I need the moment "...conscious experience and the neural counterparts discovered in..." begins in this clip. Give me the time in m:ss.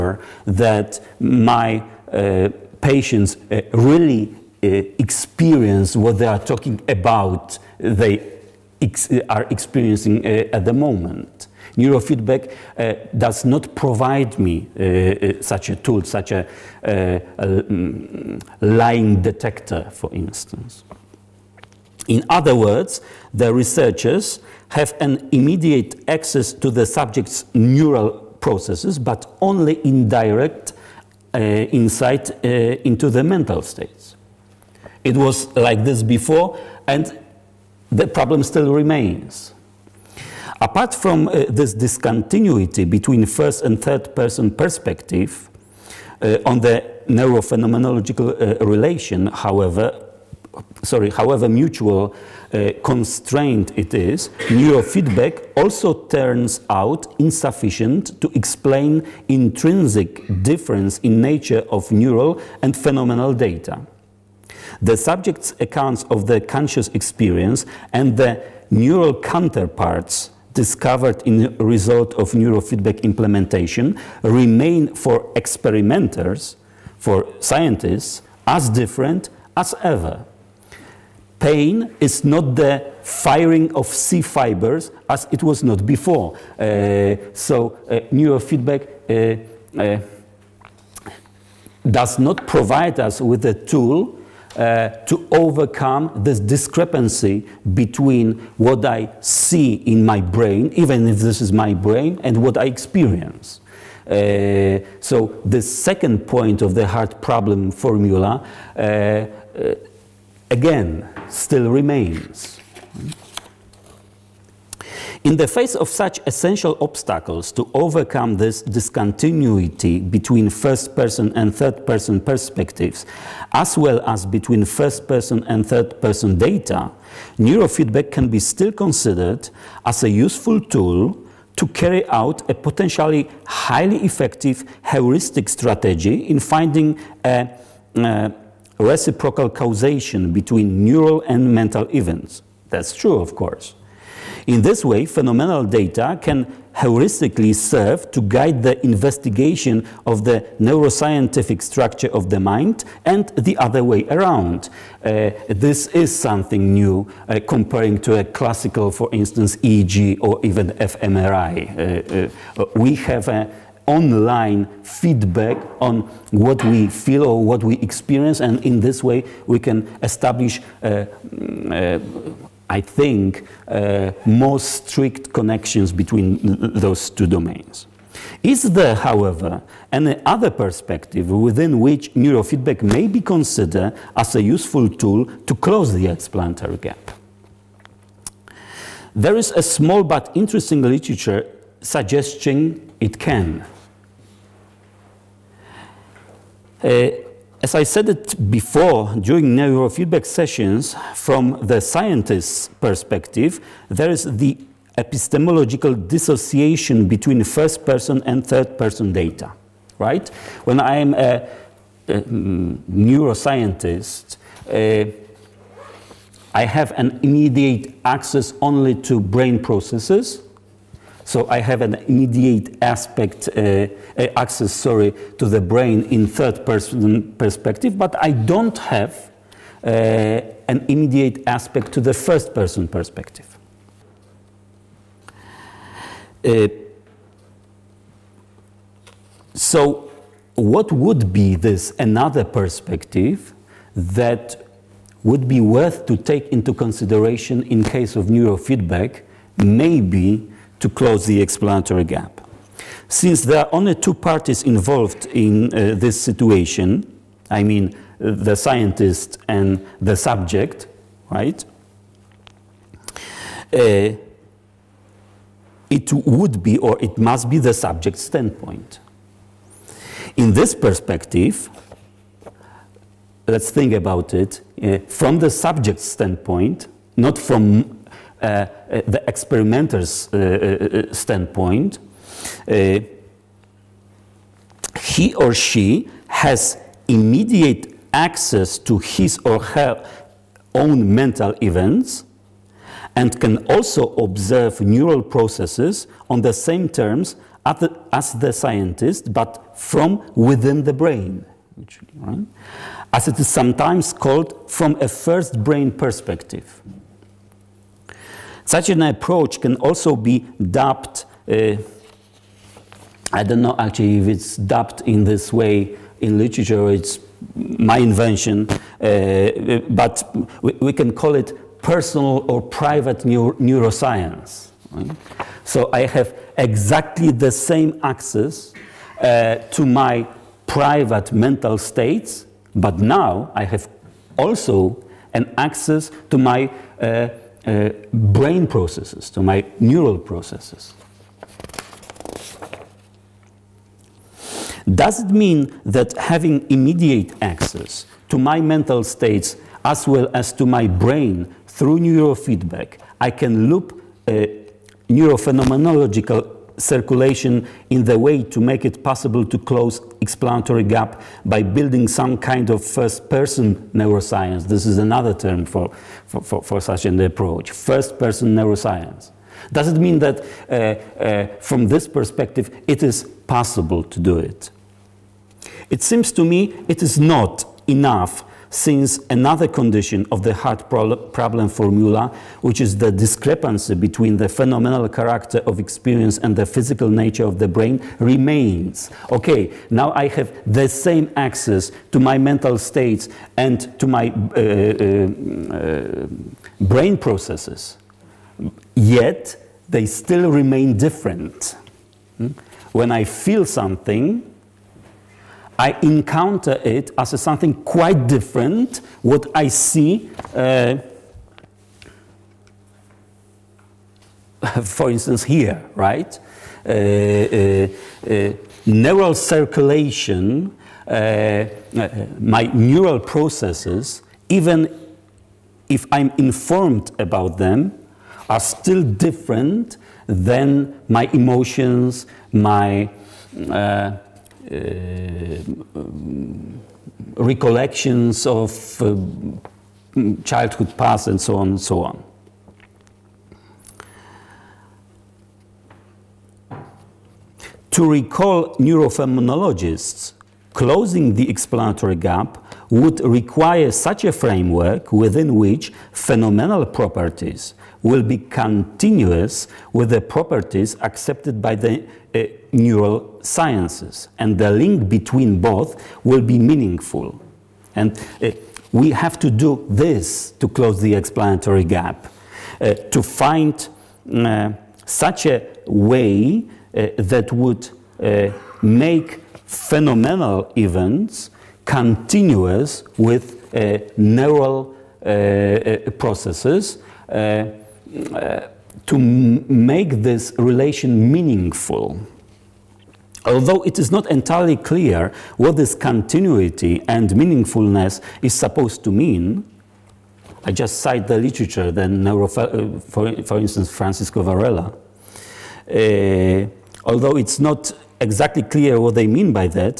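1:06.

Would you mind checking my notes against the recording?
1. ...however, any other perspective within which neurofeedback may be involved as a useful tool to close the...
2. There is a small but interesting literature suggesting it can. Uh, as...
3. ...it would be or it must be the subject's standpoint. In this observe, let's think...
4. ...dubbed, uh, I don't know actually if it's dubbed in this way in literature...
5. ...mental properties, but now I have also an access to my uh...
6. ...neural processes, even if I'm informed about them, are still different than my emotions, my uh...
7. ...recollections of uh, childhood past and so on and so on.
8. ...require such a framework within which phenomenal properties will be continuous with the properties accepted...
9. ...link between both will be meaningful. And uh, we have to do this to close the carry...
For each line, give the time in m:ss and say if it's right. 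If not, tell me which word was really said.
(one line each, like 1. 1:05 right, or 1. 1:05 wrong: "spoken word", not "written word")
1. 2:58 wrong: "considered", not "involved"
2. 3:09 right
3. 4:25 wrong: "perspective", not "observe"
4. 5:10 right
5. 5:31 wrong: "states", not "properties"
6. 7:02 right
7. 7:17 right
8. 7:33 right
9. 7:44 wrong: "explanatory", not "carry".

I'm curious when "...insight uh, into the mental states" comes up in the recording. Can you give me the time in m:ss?
0:31.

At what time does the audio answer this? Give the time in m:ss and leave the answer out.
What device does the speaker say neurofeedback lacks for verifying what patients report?
0:18.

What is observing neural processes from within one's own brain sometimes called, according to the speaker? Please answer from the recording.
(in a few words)
first brain perspective.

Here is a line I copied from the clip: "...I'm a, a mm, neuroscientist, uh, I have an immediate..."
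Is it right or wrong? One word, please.
right.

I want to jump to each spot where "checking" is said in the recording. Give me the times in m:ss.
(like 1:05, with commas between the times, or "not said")
not said.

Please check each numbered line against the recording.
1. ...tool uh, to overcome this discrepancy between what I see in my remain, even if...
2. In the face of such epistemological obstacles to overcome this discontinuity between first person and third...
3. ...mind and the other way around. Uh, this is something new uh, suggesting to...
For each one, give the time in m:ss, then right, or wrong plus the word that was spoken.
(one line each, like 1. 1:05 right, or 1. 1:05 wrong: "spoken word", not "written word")
1. 1:33 wrong: "brain", not "remain"
2. 1:55 wrong: "essential", not "epistemological"
3. 2:32 wrong: "comparing", not "suggesting".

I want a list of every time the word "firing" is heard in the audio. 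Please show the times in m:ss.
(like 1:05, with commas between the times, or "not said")
1:23.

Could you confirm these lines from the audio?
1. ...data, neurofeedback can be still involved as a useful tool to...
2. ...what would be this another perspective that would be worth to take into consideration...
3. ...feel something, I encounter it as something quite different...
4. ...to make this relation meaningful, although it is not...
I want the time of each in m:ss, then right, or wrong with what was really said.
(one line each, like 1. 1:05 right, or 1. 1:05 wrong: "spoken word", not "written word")
1. 2:06 wrong: "considered", not "involved"
2. 4:00 right
3. 6:43 right
4. 8:09 right.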